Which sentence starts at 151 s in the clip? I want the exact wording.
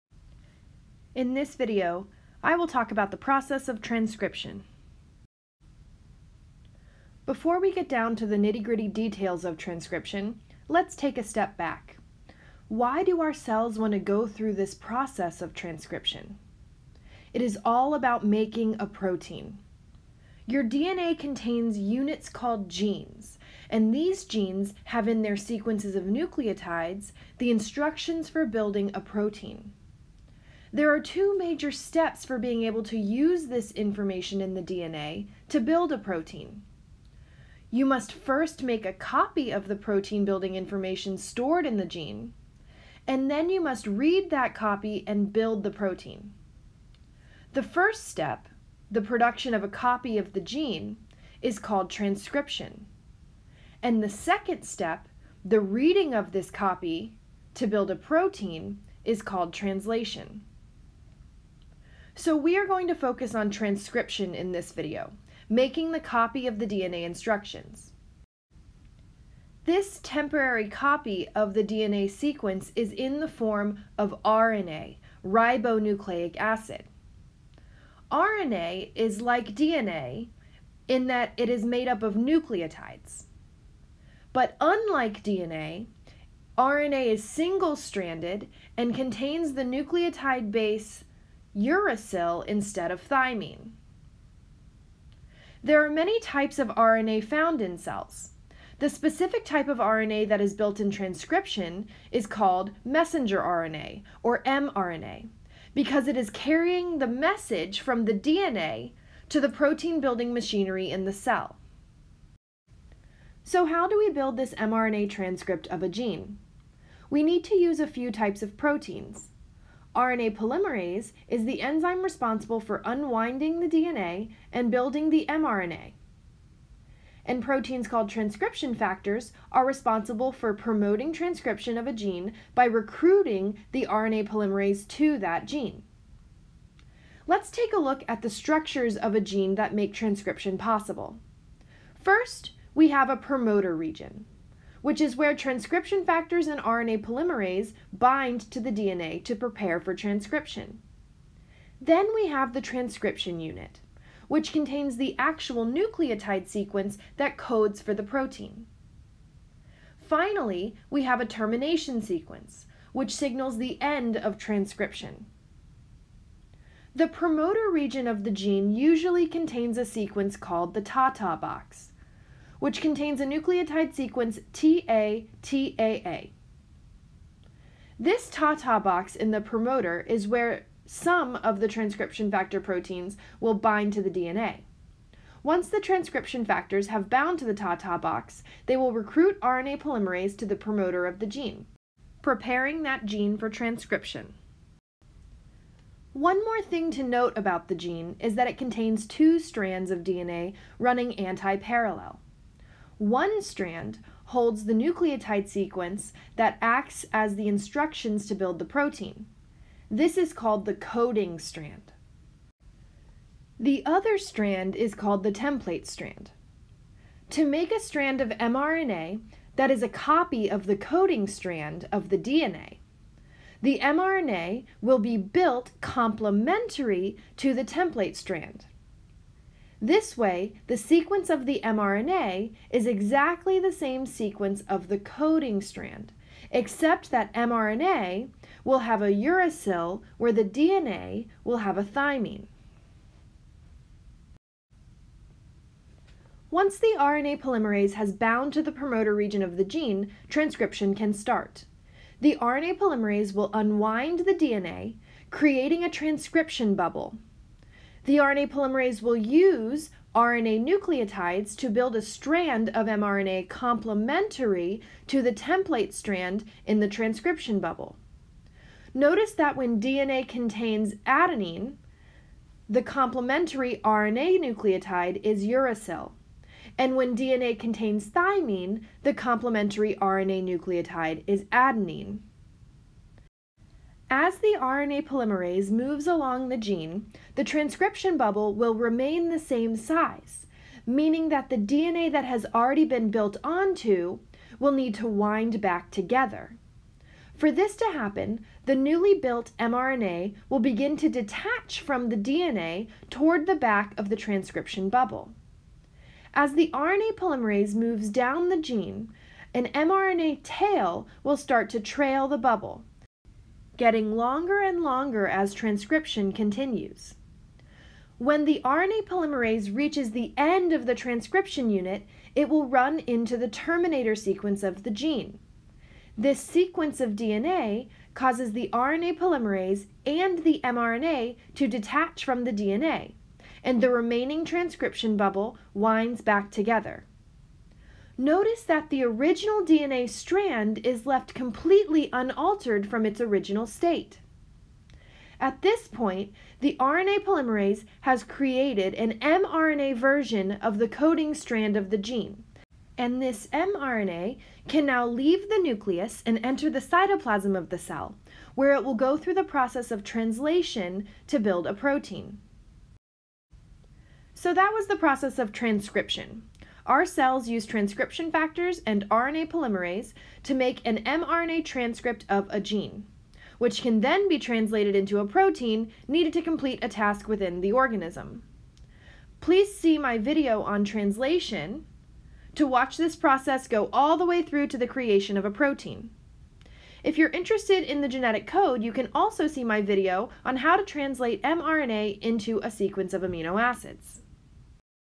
Then we have the transcription unit, which contains the actual nucleotide sequence that codes for the protein.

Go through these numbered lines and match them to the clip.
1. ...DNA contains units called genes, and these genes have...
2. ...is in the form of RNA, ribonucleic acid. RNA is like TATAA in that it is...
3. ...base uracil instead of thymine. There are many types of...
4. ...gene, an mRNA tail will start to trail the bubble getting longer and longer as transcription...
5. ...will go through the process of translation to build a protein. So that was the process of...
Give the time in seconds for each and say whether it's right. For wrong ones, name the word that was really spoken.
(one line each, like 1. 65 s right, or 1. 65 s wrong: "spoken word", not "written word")
1. 20 s right
2. 72 s wrong: "DNA", not "TATAA"
3. 90 s right
4. 308 s right
5. 358 s right.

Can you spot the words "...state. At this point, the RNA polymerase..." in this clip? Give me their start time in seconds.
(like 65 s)
343 s.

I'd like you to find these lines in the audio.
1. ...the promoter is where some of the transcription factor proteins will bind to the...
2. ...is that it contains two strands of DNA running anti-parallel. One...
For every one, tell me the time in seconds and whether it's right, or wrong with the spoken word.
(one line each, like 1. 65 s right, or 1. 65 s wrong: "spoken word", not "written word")
1. 179 s right
2. 198 s right.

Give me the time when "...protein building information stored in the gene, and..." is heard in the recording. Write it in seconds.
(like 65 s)
39 s.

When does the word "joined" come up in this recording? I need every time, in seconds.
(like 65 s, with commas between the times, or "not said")
not said.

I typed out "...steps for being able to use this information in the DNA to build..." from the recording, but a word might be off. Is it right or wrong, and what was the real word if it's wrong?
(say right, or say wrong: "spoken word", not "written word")
right.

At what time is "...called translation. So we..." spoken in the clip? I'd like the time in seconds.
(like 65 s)
59 s.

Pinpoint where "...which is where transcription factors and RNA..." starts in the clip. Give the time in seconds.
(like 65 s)
144 s.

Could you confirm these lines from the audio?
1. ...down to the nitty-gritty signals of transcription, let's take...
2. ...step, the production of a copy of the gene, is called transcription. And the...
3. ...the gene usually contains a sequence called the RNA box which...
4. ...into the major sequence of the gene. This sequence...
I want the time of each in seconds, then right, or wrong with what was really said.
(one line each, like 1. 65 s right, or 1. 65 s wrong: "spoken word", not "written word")
1. 7 s wrong: "details", not "signals"
2. 48 s right
3. 168 s wrong: "TATA", not "RNA"
4. 323 s wrong: "terminator", not "major".